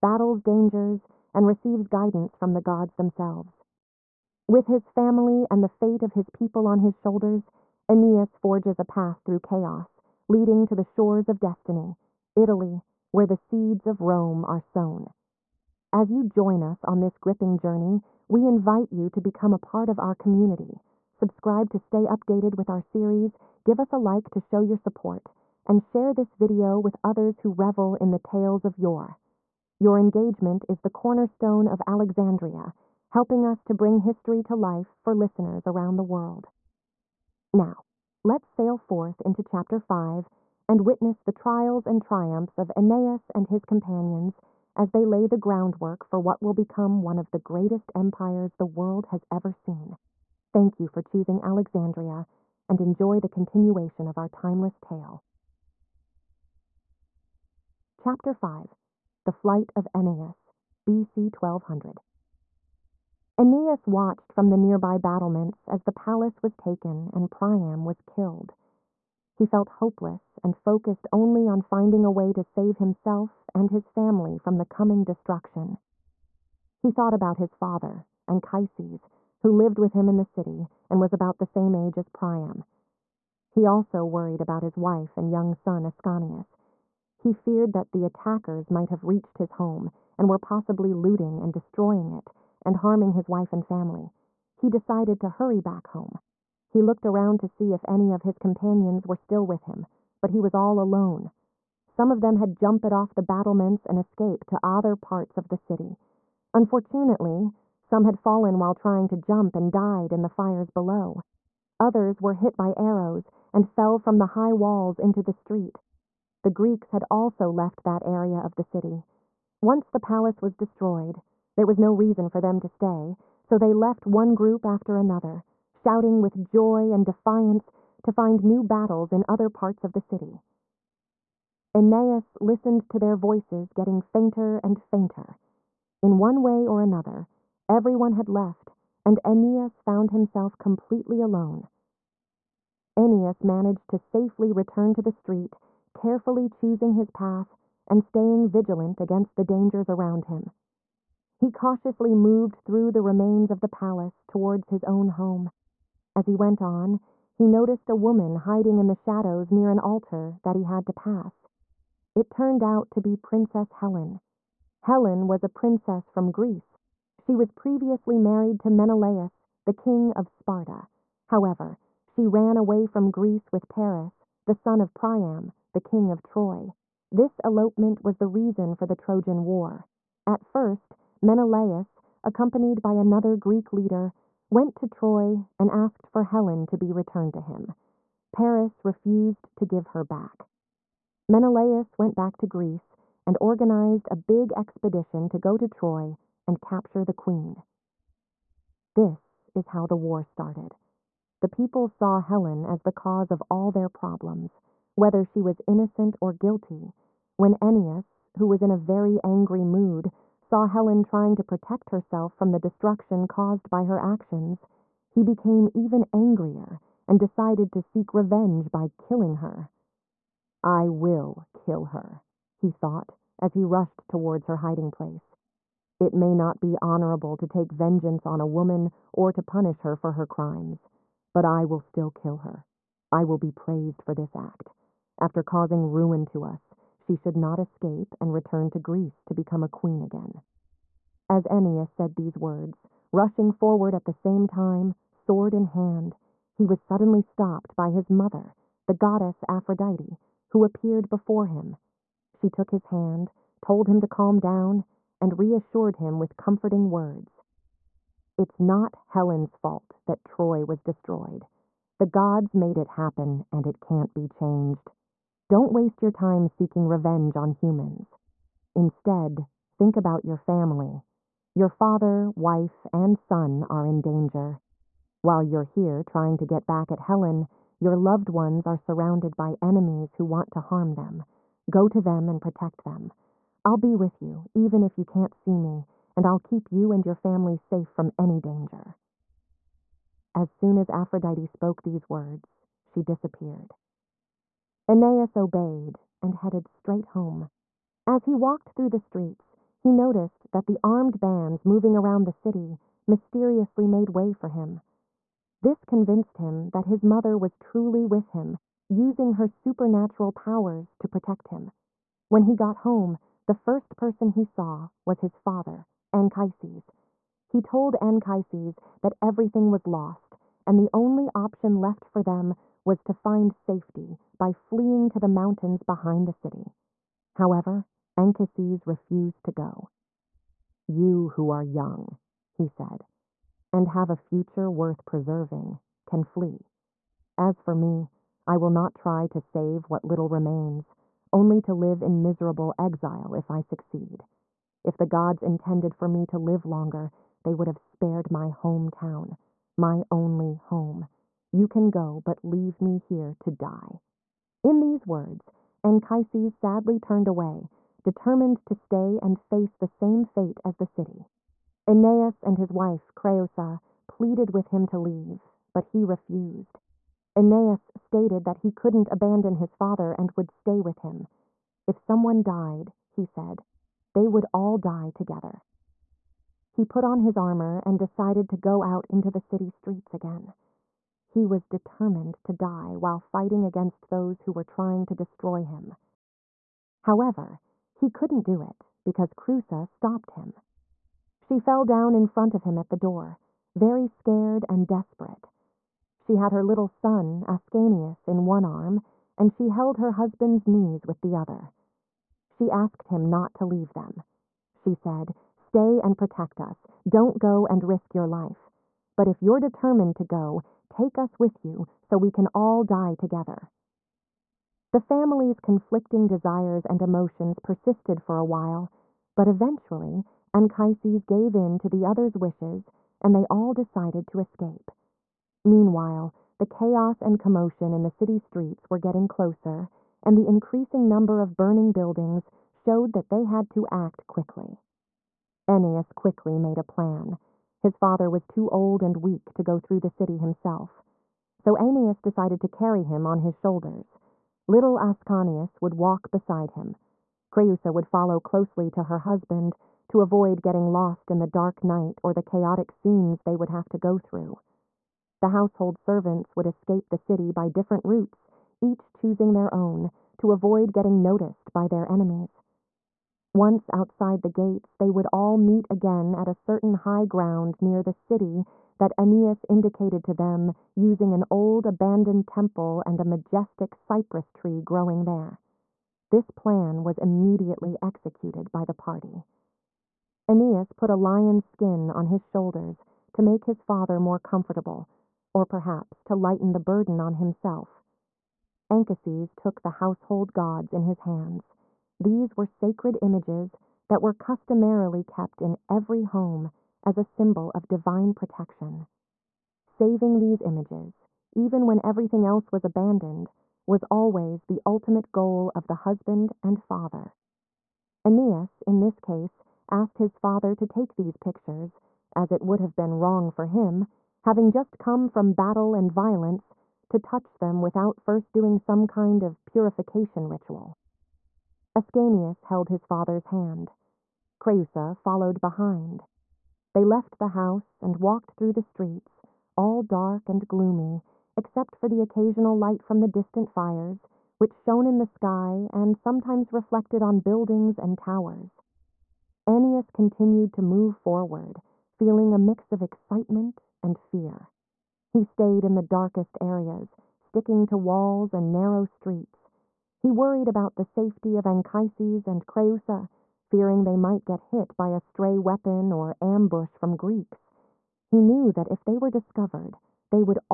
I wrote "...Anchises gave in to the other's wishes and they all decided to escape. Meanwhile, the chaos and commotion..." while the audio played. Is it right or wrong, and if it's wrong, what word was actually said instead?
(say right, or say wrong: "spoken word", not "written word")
right.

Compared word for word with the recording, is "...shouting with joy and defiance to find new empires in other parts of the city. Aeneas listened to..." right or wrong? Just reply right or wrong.
wrong.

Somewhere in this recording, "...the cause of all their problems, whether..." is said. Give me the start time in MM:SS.
03:22.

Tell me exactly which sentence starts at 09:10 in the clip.
He worried about the safety of Anchises and Creusa, fearing they might get hit by a stray weapon or ambush from Greeks.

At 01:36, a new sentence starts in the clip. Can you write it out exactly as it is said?
He looked around to see if any of his companions were still with him, but he was all alone.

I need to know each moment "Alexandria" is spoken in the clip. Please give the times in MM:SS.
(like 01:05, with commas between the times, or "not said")
00:31, 00:51.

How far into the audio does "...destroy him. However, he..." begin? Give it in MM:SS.
06:25.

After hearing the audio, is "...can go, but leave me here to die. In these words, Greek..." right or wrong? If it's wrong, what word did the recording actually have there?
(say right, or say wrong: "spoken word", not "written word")
wrong: "Anchises", not "Greek".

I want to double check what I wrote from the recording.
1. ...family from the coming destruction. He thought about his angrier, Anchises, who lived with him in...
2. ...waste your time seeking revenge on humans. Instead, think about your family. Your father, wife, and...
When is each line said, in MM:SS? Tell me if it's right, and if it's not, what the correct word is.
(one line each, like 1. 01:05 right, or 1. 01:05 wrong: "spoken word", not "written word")
1. 01:13 wrong: "father", not "angrier"
2. 04:25 right.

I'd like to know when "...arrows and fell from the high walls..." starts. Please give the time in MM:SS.
01:52.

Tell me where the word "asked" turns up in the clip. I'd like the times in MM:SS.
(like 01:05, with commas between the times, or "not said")
03:05, 06:42, 08:29.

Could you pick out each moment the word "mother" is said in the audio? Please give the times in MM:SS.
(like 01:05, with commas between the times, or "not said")
04:08, 05:07.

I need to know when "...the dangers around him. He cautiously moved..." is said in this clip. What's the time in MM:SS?
02:29.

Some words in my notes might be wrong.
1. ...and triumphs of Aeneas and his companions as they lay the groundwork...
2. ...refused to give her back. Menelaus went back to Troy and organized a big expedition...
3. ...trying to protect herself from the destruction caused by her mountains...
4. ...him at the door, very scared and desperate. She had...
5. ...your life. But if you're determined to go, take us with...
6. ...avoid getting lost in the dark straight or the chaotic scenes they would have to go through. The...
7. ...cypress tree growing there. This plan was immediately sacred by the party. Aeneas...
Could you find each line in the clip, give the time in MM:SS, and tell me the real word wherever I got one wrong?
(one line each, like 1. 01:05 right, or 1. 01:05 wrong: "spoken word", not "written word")
1. 00:41 right
2. 03:08 wrong: "Greece", not "Troy"
3. 03:31 wrong: "actions", not "mountains"
4. 06:32 right
5. 06:48 right
6. 07:30 wrong: "night", not "straight"
7. 07:53 wrong: "executed", not "sacred".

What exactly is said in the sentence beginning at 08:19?
Saving these images, even when everything else was abandoned, was always the ultimate goal of the husband and father.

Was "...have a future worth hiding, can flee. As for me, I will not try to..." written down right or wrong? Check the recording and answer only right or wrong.
wrong.